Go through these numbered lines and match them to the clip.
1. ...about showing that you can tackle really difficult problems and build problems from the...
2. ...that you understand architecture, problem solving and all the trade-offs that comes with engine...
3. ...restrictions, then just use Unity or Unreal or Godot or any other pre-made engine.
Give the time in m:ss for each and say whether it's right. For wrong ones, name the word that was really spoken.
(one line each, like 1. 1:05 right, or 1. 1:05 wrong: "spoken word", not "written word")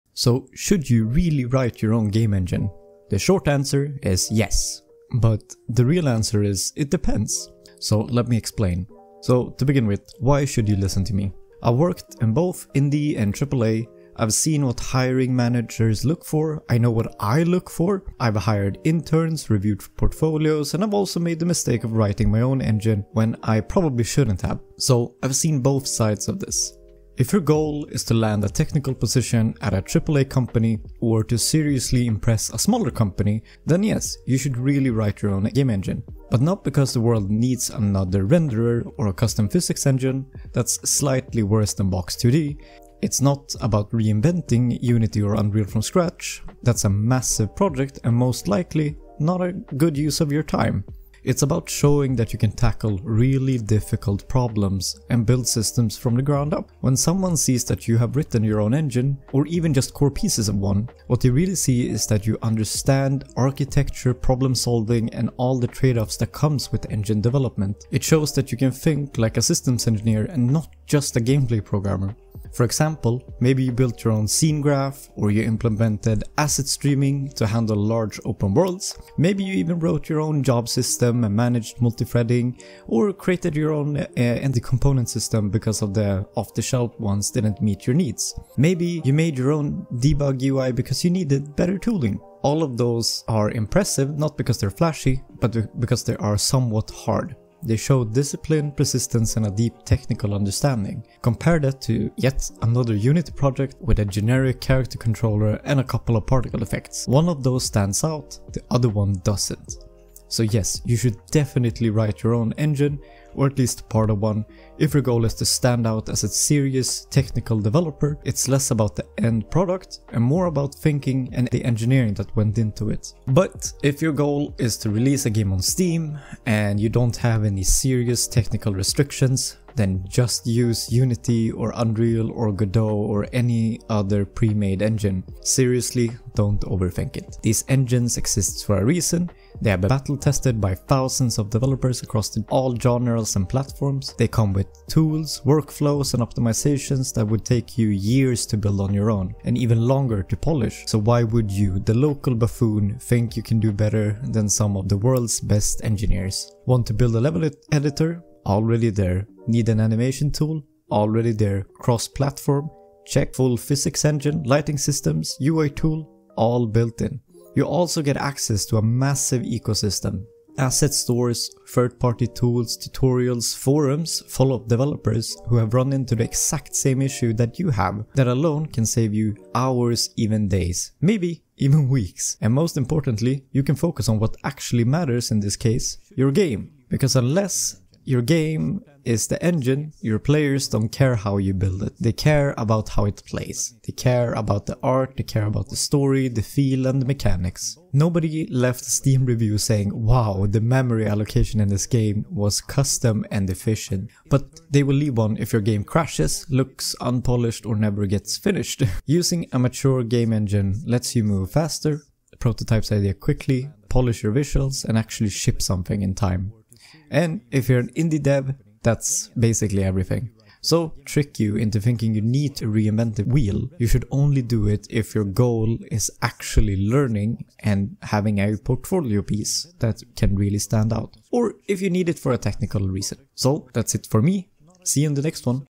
1. 0:51 wrong: "systems", not "problems"
2. 1:02 right
3. 2:08 right.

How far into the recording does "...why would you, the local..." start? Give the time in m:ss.
2:30.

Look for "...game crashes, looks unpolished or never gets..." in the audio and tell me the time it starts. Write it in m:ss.
3:25.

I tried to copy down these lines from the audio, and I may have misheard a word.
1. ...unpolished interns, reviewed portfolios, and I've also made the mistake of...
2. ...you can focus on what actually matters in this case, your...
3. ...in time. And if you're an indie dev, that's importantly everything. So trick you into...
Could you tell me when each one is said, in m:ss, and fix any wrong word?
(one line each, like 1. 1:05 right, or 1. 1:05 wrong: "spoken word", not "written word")
1. 0:18 wrong: "hired", not "unpolished"
2. 3:03 right
3. 3:36 wrong: "basically", not "importantly".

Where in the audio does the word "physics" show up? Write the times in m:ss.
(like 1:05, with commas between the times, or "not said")
0:39, 2:43.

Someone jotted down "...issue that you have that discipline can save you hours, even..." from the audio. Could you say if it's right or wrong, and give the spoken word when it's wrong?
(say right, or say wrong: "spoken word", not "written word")
wrong: "alone", not "discipline".